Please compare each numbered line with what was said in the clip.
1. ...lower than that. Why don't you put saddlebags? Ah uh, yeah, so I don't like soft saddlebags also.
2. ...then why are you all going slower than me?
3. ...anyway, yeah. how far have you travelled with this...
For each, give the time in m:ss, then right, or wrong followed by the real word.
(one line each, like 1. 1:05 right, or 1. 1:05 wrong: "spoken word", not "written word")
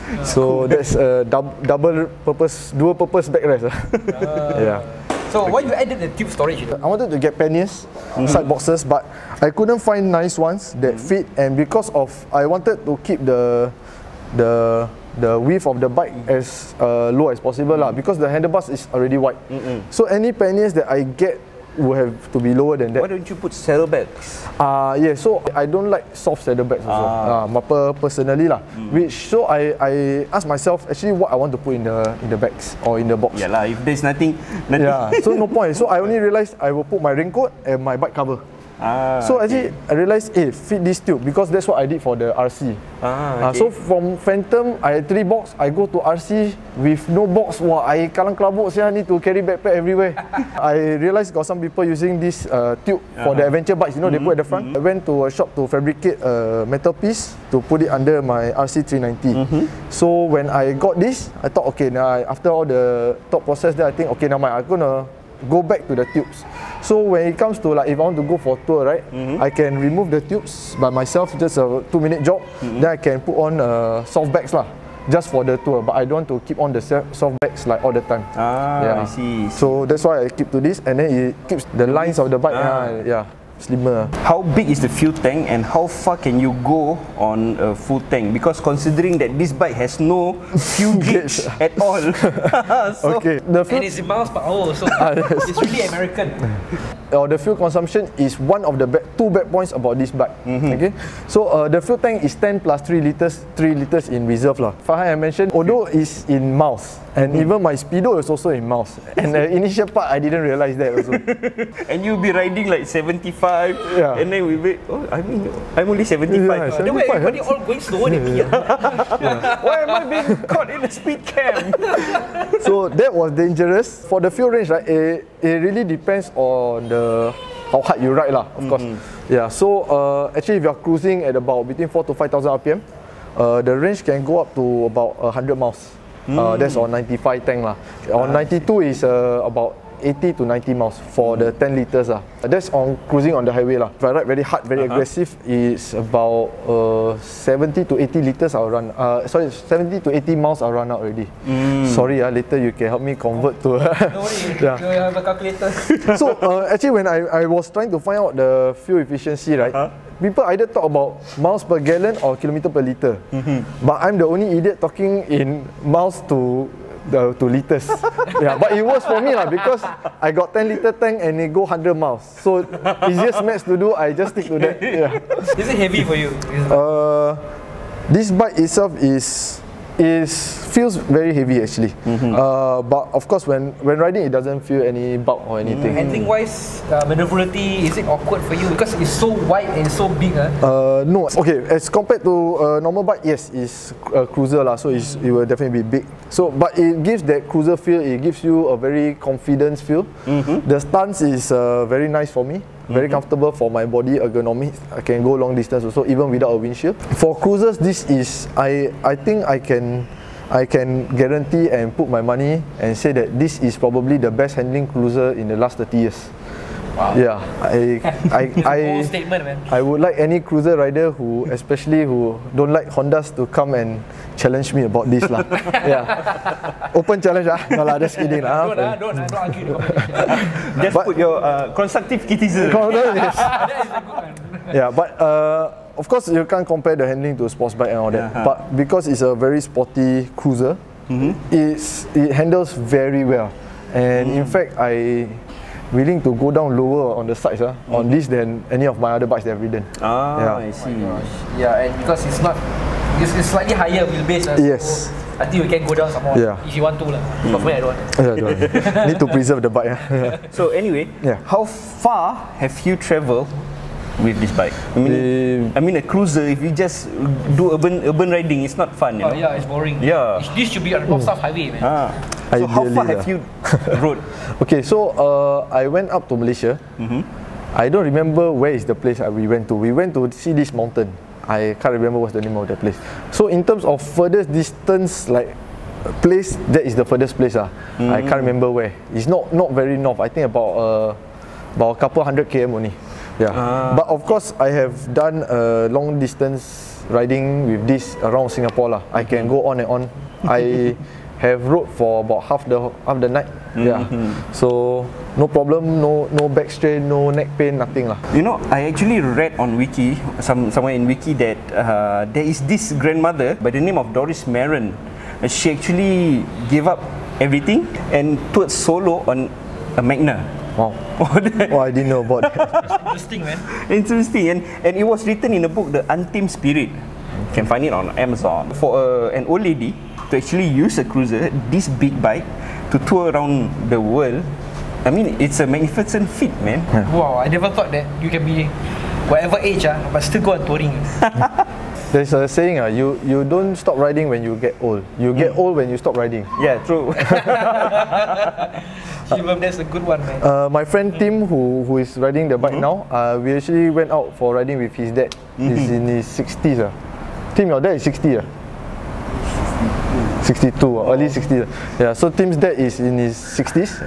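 1. 0:22 right
2. 1:56 right
3. 4:20 right.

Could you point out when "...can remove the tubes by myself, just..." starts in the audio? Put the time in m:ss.
1:09.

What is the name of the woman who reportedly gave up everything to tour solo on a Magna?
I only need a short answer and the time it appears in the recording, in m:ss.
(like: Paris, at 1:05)
Doris Maron, at 5:14.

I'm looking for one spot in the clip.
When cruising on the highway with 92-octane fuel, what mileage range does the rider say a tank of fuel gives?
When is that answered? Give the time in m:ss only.
2:20.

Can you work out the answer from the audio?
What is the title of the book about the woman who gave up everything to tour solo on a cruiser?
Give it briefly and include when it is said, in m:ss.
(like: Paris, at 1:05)
The Untamed Spirit, at 5:25.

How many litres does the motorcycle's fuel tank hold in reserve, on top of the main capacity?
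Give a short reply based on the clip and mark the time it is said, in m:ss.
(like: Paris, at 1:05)
3 liters, at 1:43.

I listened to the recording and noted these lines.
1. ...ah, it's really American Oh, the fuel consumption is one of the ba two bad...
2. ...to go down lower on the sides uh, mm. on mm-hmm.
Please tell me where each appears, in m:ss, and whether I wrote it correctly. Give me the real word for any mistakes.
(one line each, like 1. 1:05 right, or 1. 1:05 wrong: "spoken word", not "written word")
1. 1:34 right
2. 4:06 right.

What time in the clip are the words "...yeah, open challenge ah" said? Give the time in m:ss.
3:45.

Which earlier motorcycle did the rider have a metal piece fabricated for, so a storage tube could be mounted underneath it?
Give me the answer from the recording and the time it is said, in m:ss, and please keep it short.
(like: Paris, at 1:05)
RC 390, at 0:58.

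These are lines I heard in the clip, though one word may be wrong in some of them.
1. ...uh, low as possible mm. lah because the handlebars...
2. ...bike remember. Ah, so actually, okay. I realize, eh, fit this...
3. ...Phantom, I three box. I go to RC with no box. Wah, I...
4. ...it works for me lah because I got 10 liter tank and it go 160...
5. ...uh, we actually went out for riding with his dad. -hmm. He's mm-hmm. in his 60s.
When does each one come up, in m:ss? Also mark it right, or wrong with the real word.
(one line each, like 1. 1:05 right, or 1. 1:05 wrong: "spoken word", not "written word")
1. 0:16 right
2. 0:37 wrong: "cover", not "remember"
3. 0:44 right
4. 2:48 wrong: "100", not "160"
5. 5:53 right.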